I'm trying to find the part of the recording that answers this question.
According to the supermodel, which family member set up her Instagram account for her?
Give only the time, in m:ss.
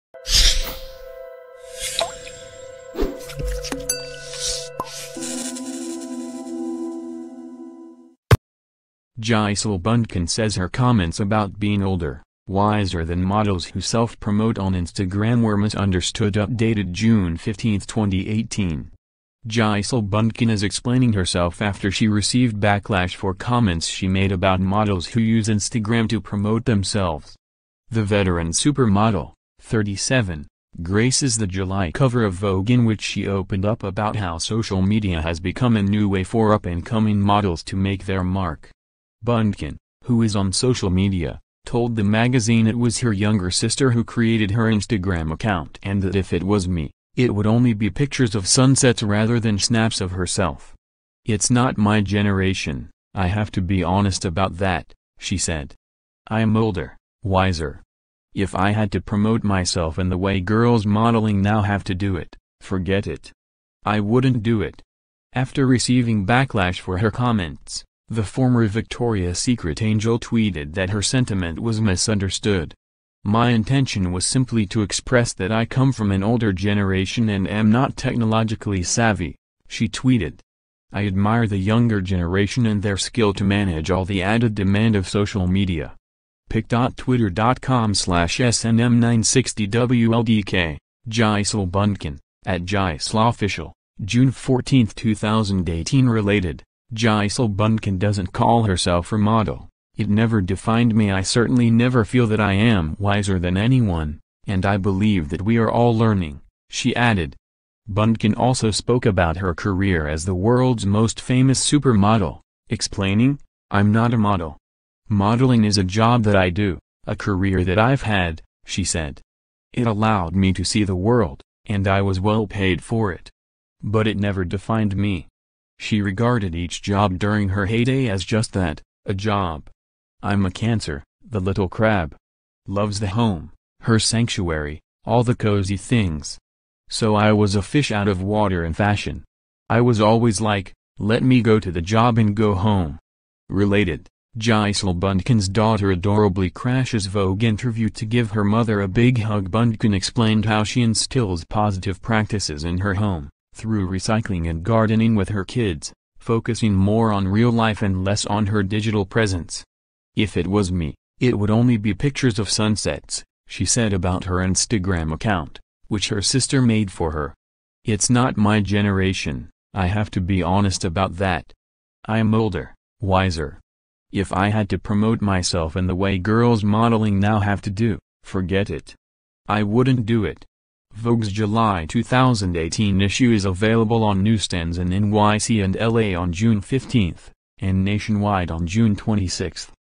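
0:43.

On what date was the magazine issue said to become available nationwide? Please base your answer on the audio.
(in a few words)
June 26.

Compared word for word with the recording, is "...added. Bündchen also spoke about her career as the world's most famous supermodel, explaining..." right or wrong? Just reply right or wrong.
right.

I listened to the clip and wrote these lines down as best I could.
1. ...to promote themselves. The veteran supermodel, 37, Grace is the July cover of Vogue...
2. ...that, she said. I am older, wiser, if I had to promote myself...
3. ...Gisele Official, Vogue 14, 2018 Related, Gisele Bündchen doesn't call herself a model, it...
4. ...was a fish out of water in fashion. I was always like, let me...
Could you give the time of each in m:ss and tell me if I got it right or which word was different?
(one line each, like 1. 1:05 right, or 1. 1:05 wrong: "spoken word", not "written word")
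1. 0:26 right
2. 0:54 right
3. 1:32 wrong: "June", not "Vogue"
4. 2:17 right.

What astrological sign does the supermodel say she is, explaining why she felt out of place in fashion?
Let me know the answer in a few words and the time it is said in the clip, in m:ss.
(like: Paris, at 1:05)
Cancer, at 2:10.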